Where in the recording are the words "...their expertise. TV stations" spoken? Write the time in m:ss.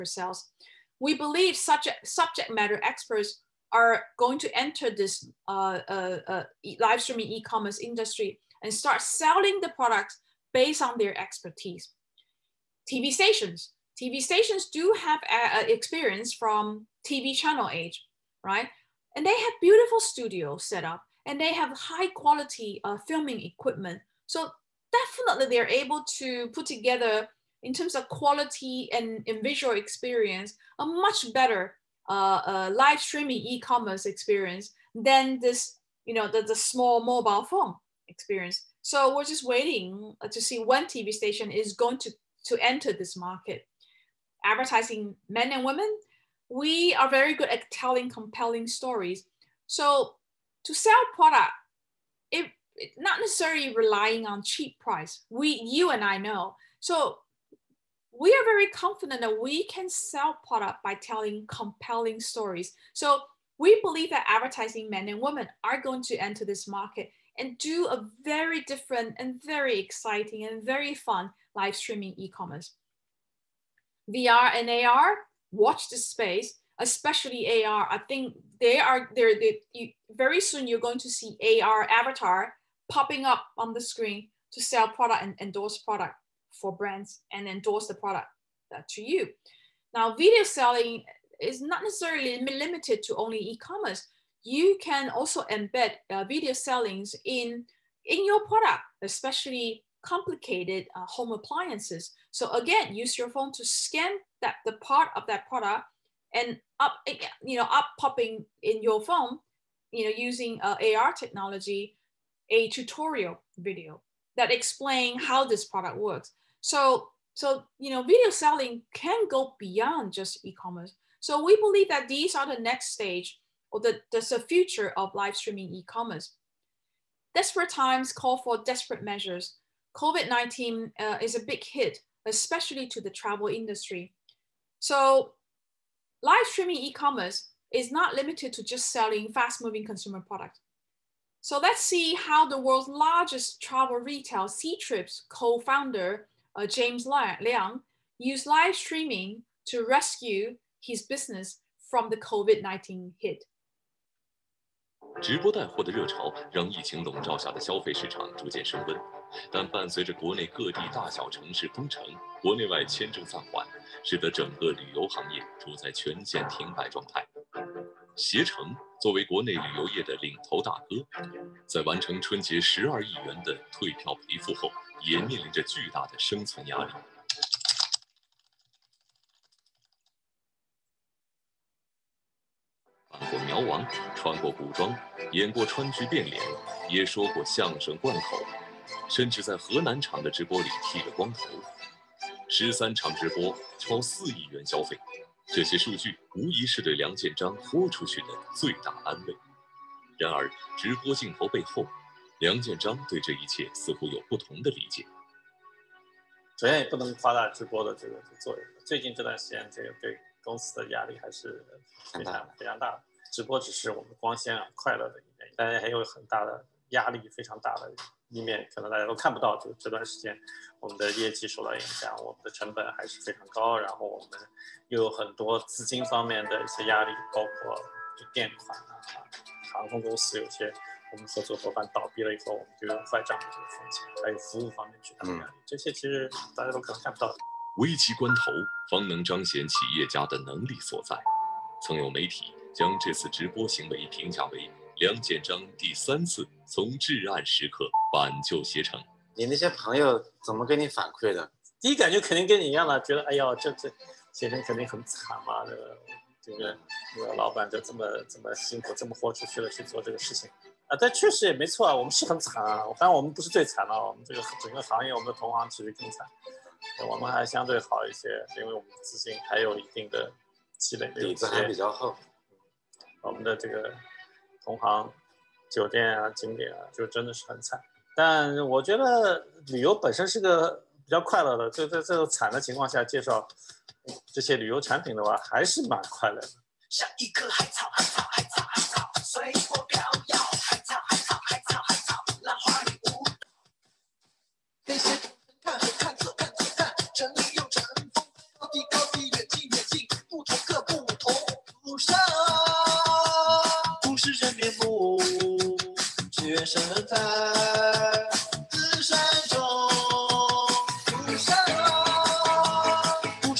0:10.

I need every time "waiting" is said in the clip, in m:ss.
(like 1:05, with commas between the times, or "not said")
0:39.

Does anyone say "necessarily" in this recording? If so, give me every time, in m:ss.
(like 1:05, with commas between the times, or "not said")
0:53, 1:31.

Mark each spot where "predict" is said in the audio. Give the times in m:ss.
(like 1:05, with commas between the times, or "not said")
not said.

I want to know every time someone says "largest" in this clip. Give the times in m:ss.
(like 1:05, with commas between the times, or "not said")
2:22.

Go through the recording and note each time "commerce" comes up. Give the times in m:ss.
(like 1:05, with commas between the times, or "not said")
0:07, 0:33, 1:12, 1:33, 2:00, 2:05, 2:16.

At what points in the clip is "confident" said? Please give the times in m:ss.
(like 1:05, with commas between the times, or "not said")
0:58.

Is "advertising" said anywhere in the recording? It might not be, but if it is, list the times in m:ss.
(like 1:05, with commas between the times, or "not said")
0:44, 1:04.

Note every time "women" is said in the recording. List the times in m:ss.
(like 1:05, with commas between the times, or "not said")
0:45, 1:05.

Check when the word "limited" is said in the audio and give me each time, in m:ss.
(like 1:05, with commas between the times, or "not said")
1:32, 2:18.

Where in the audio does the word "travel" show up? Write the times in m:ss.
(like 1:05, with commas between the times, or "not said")
2:13, 2:23.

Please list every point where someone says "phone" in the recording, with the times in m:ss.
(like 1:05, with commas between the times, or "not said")
0:37, 1:43, 1:49.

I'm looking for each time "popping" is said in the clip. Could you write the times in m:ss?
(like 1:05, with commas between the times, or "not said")
1:22, 1:47.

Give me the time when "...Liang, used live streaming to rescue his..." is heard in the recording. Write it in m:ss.
2:27.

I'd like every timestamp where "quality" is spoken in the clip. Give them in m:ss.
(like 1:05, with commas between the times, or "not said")
0:22, 0:28.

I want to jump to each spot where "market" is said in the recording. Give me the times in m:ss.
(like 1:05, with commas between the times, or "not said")
0:43, 1:06.